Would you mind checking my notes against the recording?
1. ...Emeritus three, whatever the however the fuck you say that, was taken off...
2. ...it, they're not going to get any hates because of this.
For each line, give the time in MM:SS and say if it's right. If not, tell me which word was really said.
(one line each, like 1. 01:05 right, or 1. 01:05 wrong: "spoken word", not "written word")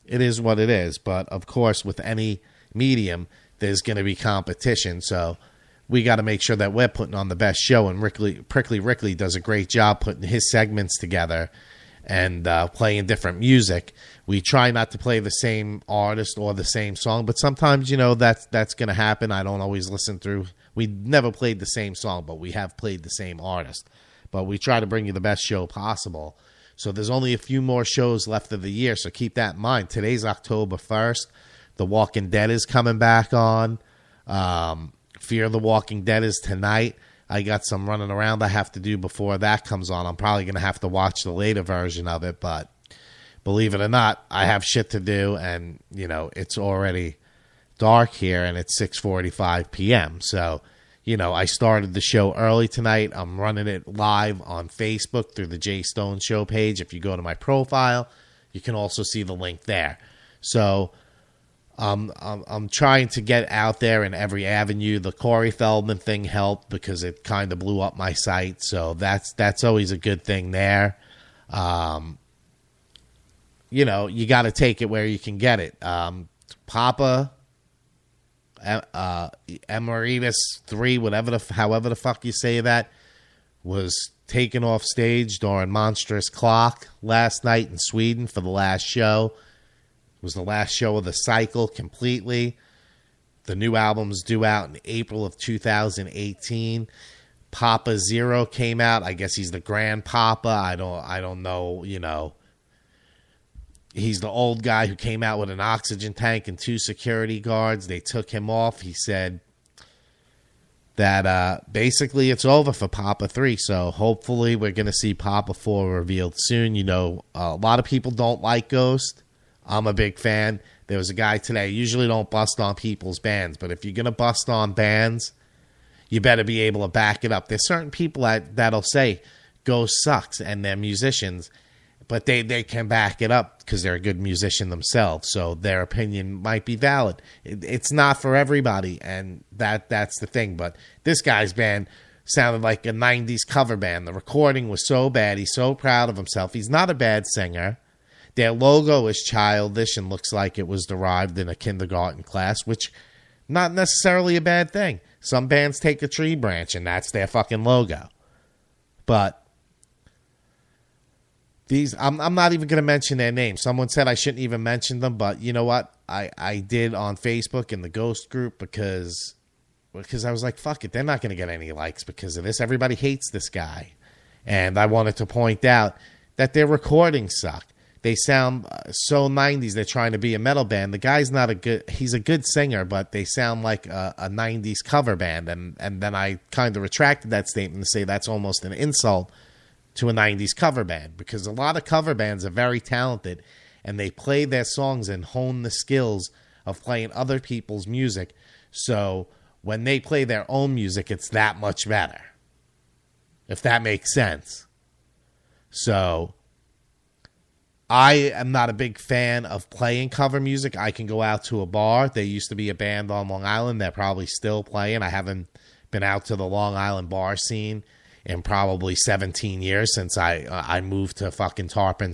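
1. 01:19 right
2. 02:50 wrong: "likes", not "hates".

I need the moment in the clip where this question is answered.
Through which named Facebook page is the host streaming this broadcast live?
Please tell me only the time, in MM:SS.
00:55.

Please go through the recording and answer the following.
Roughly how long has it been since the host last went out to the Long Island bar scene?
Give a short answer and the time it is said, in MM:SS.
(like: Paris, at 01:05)
17 years, at 03:38.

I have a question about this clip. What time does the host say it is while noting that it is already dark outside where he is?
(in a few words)
6:45 p.m.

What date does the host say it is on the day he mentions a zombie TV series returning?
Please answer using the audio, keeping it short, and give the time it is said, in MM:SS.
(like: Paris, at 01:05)
October 1st, at 00:30.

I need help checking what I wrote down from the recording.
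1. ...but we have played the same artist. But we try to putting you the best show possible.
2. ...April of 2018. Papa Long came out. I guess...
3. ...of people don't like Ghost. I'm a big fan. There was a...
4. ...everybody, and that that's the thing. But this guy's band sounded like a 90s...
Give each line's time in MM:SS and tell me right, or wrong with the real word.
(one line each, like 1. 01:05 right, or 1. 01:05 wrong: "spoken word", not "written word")
1. 00:22 wrong: "bring", not "putting"
2. 01:34 wrong: "Zero", not "Long"
3. 01:57 right
4. 02:18 right.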